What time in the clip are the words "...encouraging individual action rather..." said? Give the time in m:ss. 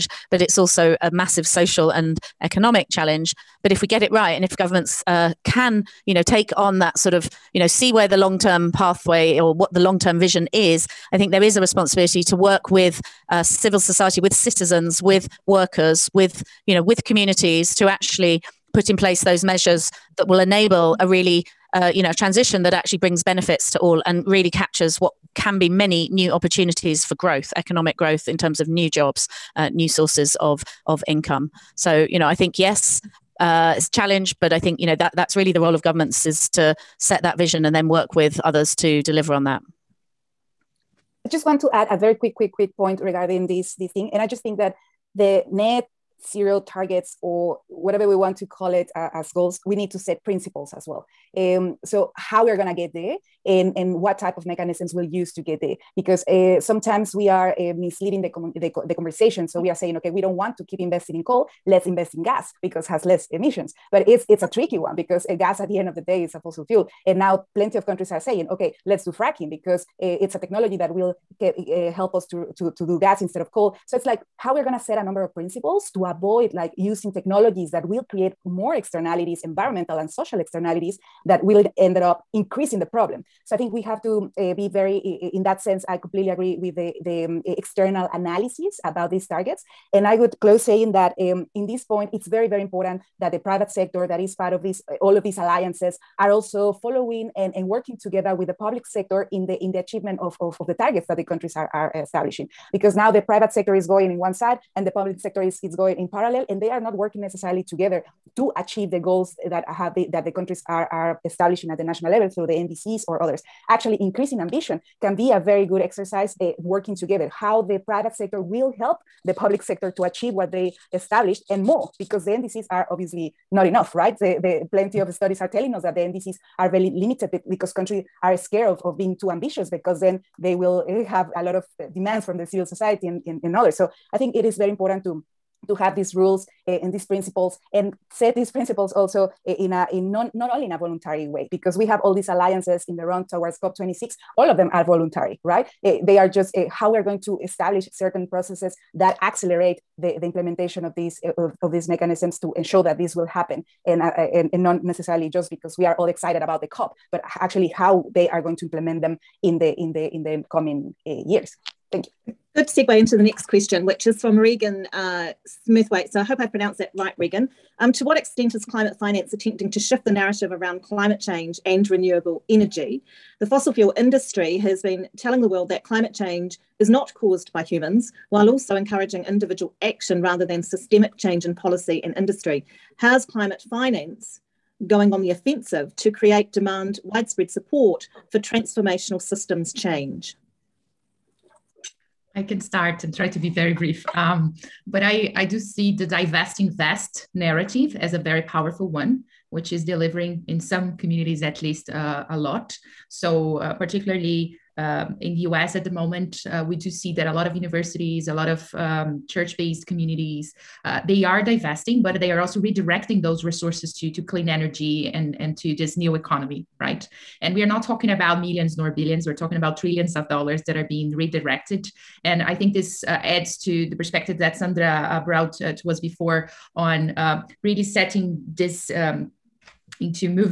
2:58.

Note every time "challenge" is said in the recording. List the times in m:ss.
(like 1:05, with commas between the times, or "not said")
0:02, 0:33.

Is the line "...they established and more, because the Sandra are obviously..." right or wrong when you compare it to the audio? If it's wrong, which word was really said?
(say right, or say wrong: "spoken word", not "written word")
wrong: "NDCs", not "Sandra".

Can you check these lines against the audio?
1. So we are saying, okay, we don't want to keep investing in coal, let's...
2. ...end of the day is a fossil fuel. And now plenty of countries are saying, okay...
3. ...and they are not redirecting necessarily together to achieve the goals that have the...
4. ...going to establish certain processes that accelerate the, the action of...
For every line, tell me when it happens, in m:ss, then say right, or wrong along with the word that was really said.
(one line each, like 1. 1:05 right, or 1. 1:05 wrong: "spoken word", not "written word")
1. 0:59 right
2. 1:05 right
3. 1:46 wrong: "working", not "redirecting"
4. 2:27 wrong: "implementation", not "action".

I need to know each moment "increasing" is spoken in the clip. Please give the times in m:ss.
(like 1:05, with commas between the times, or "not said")
1:22, 1:54.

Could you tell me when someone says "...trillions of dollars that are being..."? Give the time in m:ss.
3:39.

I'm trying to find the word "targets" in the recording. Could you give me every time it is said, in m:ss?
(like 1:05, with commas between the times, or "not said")
0:46, 1:29, 1:40.